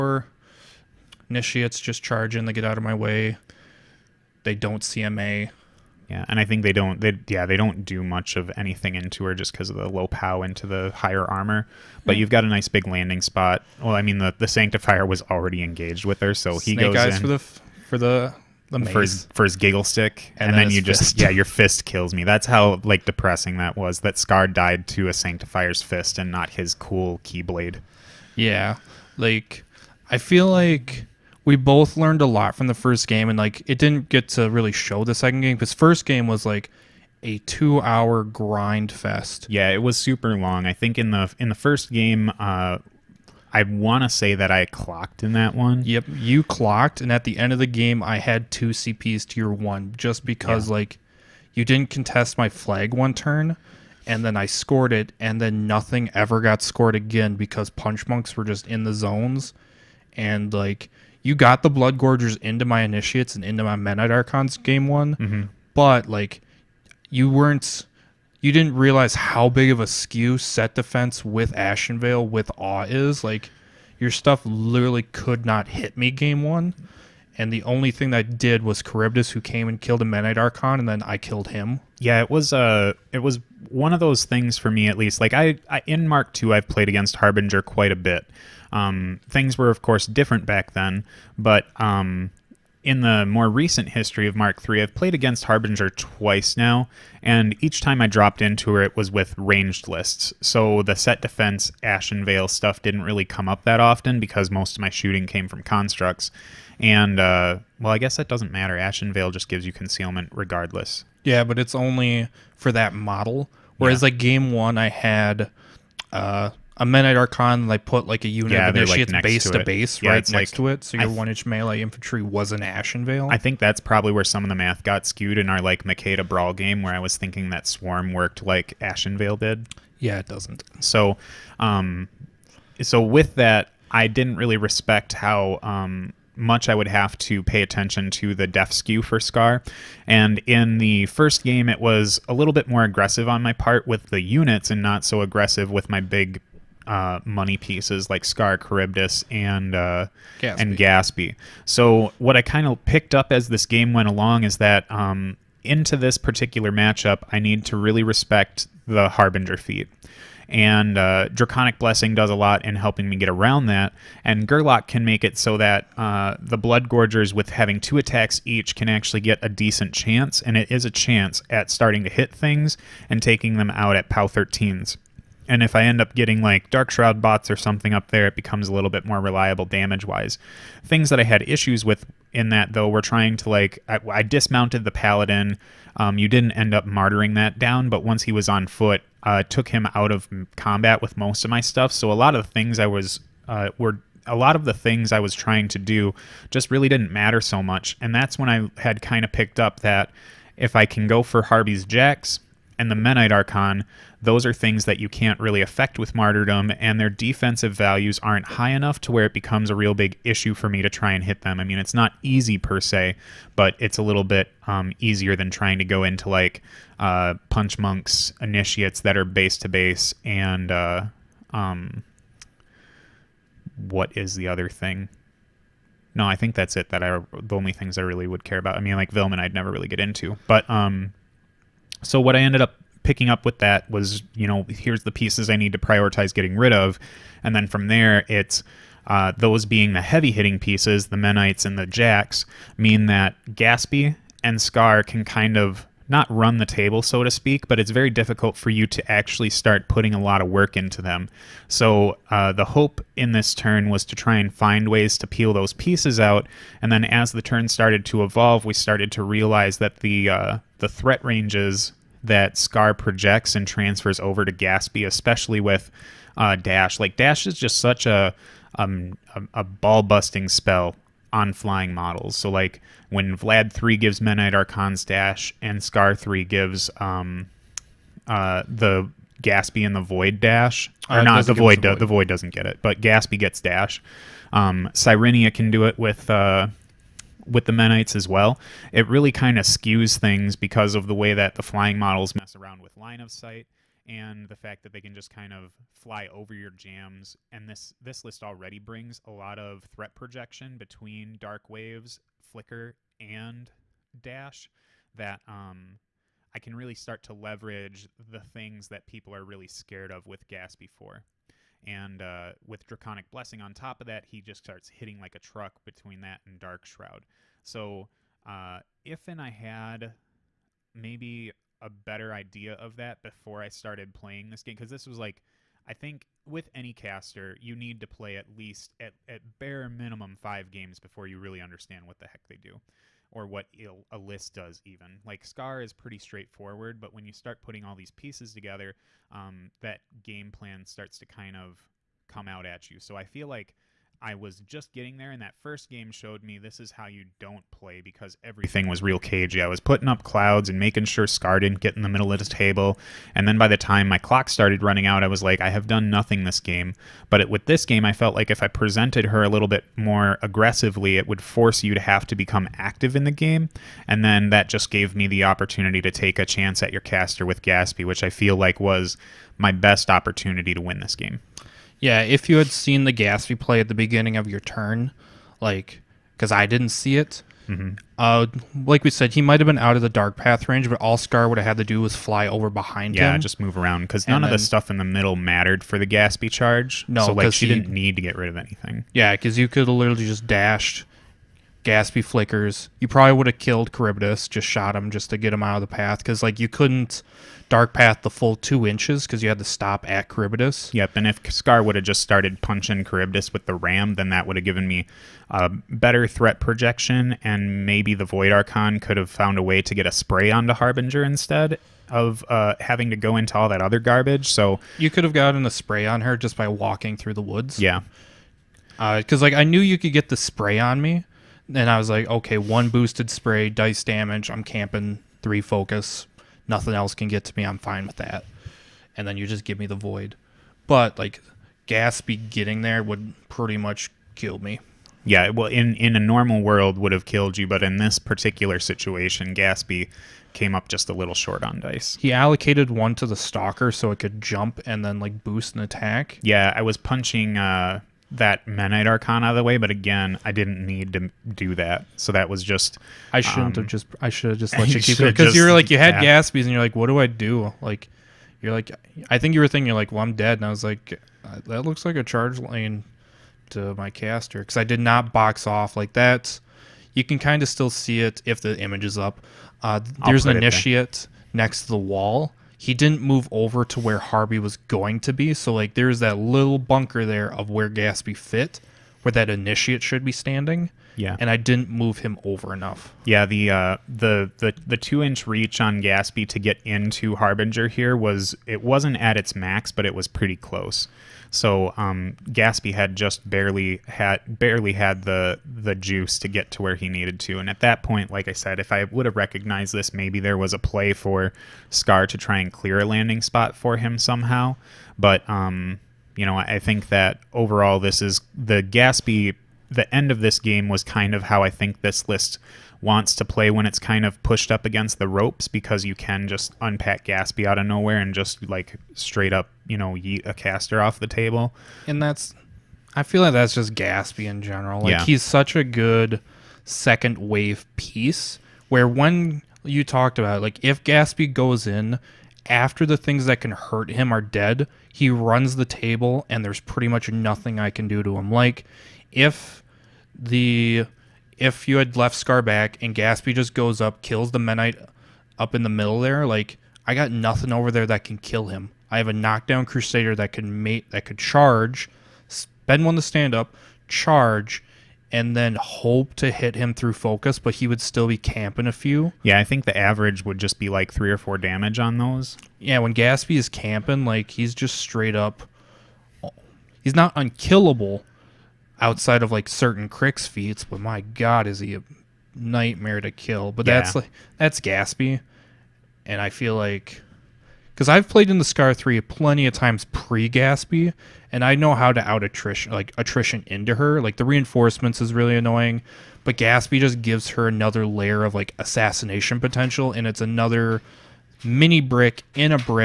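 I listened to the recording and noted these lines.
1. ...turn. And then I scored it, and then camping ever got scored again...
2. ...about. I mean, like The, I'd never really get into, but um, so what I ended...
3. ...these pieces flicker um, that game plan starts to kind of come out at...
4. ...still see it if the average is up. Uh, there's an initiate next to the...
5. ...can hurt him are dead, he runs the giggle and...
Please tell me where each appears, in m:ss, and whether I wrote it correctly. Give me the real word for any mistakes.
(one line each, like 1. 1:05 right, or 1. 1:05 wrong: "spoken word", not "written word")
1. 0:53 wrong: "nothing", not "camping"
2. 3:48 wrong: "Vilmon", not "The"
3. 5:37 wrong: "together", not "flicker"
4. 7:47 wrong: "image", not "average"
5. 8:53 wrong: "table", not "giggle".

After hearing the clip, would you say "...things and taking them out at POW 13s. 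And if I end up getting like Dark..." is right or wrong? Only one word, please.
right.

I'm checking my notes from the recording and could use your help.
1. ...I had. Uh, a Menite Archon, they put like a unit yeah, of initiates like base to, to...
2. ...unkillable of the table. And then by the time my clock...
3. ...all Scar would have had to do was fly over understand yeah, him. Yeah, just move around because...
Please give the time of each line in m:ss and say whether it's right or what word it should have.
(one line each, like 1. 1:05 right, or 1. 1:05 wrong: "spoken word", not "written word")
1. 1:54 right
2. 5:52 wrong: "middle", not "unkillable"
3. 6:21 wrong: "behind", not "understand".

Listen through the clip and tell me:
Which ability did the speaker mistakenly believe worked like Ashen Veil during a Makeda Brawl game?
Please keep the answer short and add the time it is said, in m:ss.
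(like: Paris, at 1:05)
Swarm, at 2:07.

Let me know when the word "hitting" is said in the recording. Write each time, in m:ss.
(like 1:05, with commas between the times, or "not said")
4:00, 5:14.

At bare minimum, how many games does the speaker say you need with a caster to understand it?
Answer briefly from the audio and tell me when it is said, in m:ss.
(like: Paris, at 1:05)
5, at 5:30.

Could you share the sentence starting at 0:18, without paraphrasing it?
The for, his, for his giggle stick and, and then, then you fist.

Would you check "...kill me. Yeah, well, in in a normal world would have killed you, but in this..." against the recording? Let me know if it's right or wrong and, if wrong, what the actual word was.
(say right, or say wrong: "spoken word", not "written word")
right.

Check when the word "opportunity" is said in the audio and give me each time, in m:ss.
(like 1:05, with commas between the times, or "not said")
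6:05, 6:10.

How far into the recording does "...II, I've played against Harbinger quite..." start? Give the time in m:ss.
1:26.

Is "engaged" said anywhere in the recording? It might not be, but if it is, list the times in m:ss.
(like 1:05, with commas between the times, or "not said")
0:15.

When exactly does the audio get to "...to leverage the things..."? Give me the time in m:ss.
5:07.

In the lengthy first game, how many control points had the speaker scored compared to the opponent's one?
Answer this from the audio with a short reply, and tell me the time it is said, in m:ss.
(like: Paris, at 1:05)
2, at 0:48.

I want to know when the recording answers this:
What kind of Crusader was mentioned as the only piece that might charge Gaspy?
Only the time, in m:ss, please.
9:09.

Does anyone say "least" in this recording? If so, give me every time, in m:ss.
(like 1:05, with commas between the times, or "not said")
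1:24, 5:28.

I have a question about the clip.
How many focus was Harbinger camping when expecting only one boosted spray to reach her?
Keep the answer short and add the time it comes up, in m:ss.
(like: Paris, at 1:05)
3, at 7:05.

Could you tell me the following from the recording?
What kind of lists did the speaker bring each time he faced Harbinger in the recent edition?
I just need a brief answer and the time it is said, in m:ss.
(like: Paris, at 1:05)
ranged lists, at 1:39.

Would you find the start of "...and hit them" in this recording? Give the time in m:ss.
3:31.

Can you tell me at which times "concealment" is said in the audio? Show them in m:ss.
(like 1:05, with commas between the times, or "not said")
1:49.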